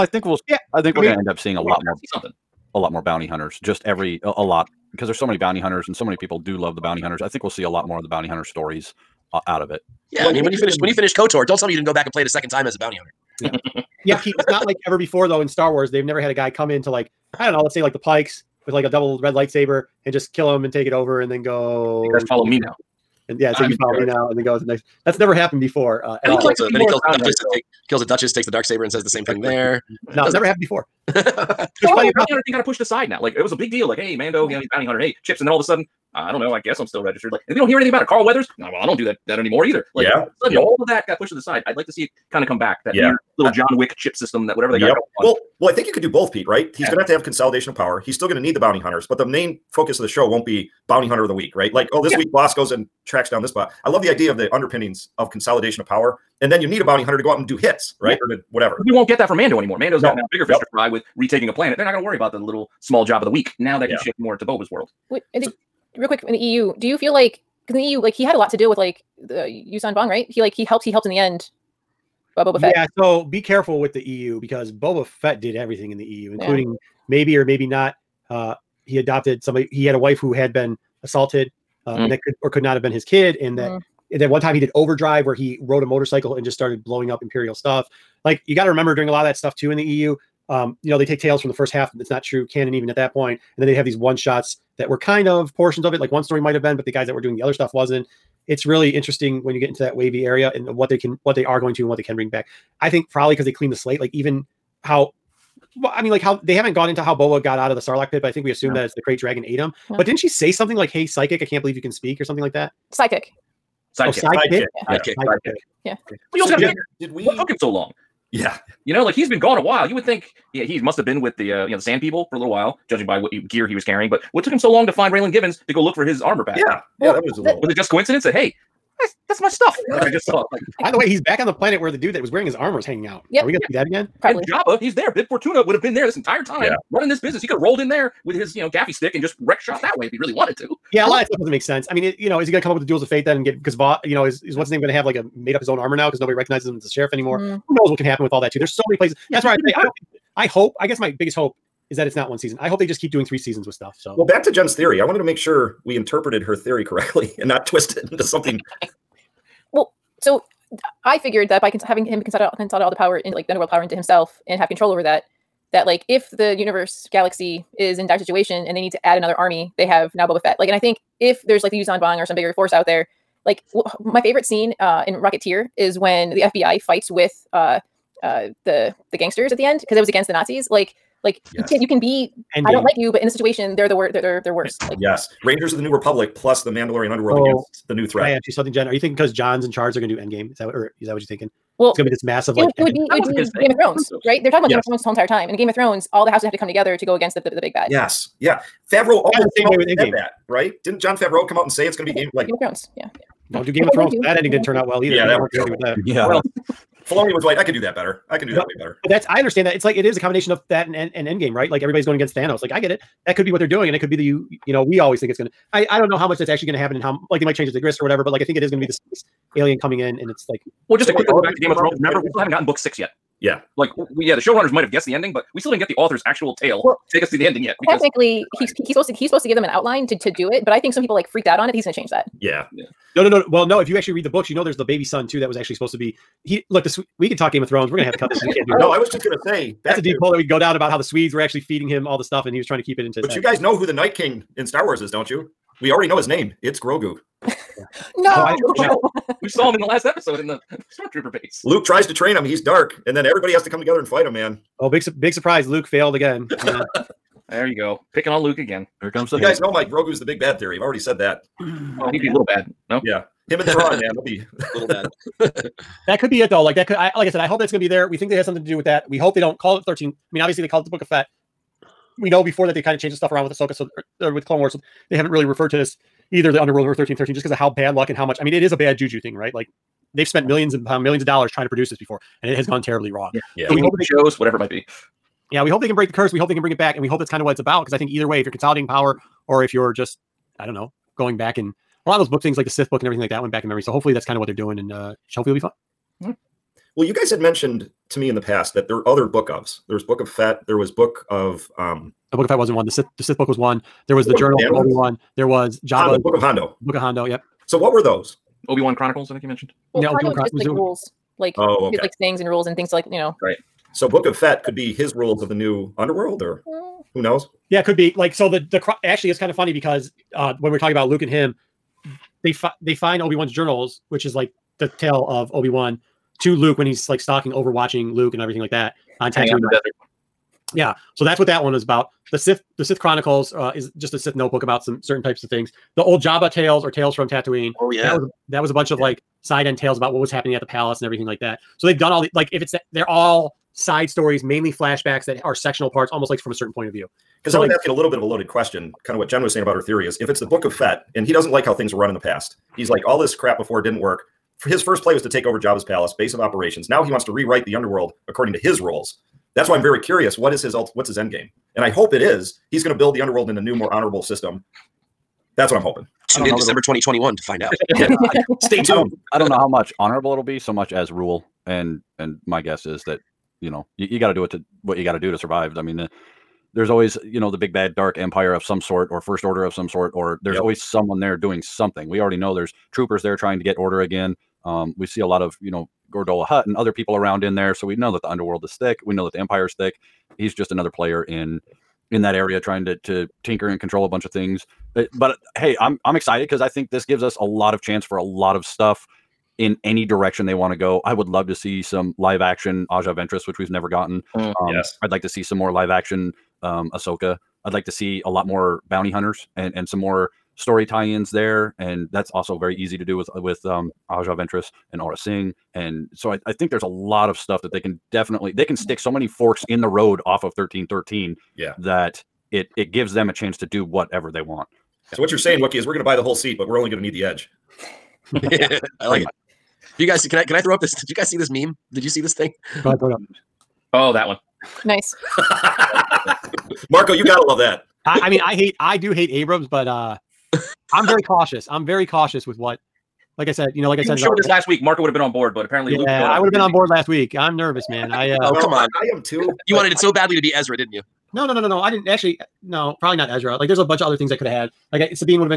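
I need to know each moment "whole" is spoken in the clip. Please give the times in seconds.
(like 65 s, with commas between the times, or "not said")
195 s, 426 s.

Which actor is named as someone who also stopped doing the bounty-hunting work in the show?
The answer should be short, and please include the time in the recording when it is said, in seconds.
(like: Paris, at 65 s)
Carl Weathers, at 38 s.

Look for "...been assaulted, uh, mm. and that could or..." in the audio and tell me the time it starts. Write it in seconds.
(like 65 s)
80 s.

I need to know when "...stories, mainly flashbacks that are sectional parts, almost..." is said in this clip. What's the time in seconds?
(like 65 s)
344 s.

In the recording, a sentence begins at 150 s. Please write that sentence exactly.
I guess my biggest hope is that it's not one season.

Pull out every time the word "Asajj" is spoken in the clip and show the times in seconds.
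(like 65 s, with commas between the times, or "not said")
402 s, 414 s.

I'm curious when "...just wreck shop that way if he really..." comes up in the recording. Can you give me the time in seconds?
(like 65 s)
139 s.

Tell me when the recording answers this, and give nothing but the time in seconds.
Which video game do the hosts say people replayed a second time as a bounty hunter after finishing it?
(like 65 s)
11 s.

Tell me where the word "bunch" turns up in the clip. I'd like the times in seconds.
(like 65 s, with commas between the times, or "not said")
338 s, 394 s, 453 s.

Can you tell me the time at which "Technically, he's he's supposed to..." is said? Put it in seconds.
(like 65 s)
227 s.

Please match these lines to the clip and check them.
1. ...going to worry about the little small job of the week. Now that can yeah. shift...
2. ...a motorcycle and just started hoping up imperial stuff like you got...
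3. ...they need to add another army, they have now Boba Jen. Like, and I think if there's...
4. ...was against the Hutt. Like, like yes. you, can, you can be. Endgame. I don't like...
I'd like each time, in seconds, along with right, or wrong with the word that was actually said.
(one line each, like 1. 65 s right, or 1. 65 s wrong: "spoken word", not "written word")
1. 61 s right
2. 85 s wrong: "blowing", not "hoping"
3. 168 s wrong: "Fett", not "Jen"
4. 180 s wrong: "Nazis", not "Hutt".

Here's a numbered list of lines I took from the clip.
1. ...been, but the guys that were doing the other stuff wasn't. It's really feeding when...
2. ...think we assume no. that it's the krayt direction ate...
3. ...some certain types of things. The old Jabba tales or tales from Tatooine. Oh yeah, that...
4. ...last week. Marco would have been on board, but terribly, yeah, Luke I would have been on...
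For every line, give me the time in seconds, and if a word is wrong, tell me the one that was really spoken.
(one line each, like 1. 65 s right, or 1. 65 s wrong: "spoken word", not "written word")
1. 96 s wrong: "interesting", not "feeding"
2. 108 s wrong: "dragon", not "direction"
3. 334 s right
4. 444 s wrong: "apparently", not "terribly".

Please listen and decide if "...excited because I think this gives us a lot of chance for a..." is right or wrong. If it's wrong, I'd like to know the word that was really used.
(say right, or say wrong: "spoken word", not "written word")
right.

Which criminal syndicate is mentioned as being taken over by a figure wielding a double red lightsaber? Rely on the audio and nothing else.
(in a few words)
The Pikes.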